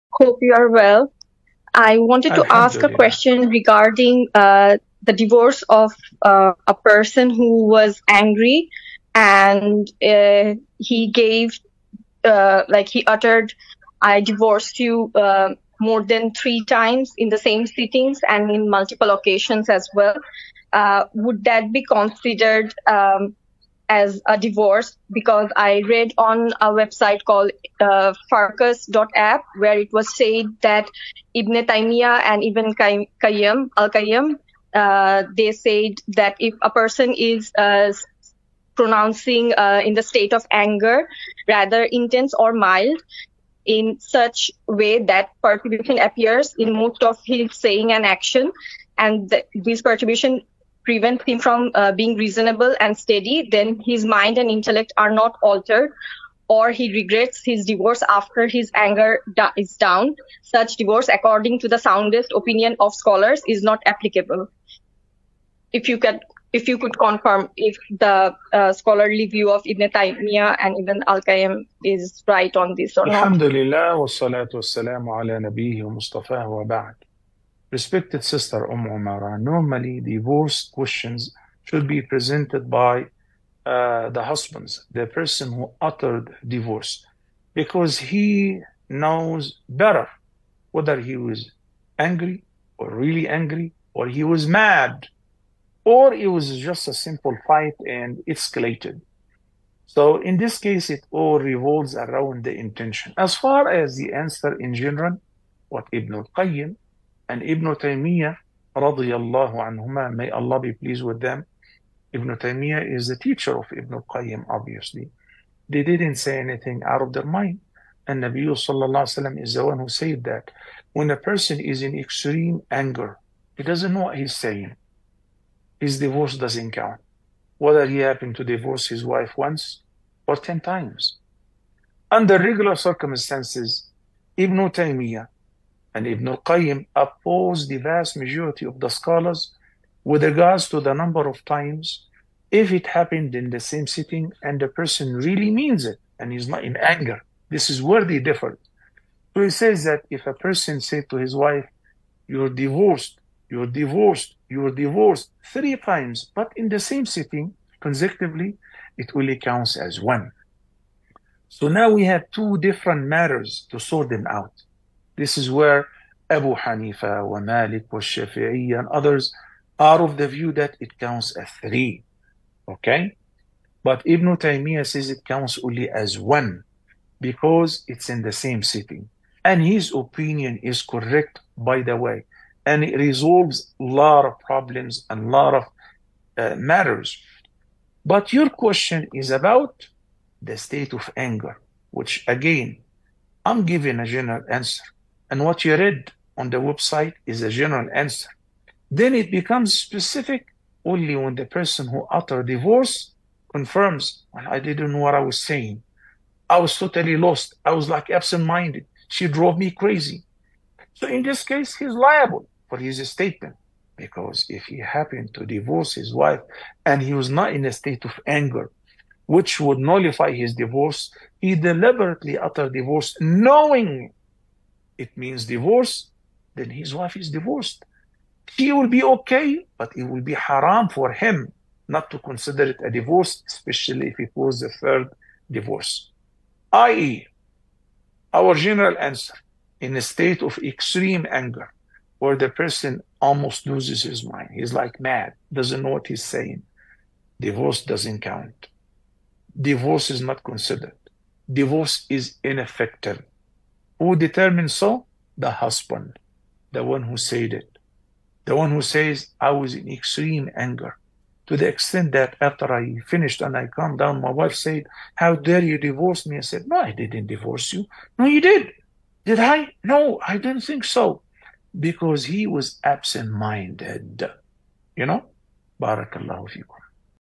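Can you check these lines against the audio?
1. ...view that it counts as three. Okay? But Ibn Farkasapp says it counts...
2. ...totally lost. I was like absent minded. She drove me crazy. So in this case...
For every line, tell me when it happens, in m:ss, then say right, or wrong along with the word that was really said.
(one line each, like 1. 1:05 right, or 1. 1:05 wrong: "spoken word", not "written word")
1. 2:50 wrong: "Taymiyyah", not "Farkasapp"
2. 3:26 right.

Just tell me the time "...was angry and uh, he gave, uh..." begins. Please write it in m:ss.
0:07.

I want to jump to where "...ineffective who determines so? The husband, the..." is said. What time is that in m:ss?
4:12.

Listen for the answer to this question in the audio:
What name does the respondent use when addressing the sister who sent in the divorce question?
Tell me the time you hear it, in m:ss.
1:18.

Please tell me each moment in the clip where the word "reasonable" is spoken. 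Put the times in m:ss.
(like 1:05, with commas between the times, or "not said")
0:52.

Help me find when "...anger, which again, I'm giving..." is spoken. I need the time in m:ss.
3:11.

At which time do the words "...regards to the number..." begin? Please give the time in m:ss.
2:20.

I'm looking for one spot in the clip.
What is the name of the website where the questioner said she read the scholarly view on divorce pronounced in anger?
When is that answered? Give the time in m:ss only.
0:28.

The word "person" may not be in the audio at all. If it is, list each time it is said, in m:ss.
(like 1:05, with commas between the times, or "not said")
0:06, 0:36, 1:25, 2:01, 2:24, 2:30, 3:21, 4:02.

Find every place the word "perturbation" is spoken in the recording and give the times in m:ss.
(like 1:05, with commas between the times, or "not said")
0:45, 0:49.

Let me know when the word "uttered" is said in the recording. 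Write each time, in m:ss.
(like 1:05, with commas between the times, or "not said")
0:13, 1:25, 3:22, 3:42.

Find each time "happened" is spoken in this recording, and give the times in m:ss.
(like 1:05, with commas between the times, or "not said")
2:07, 2:22, 3:34.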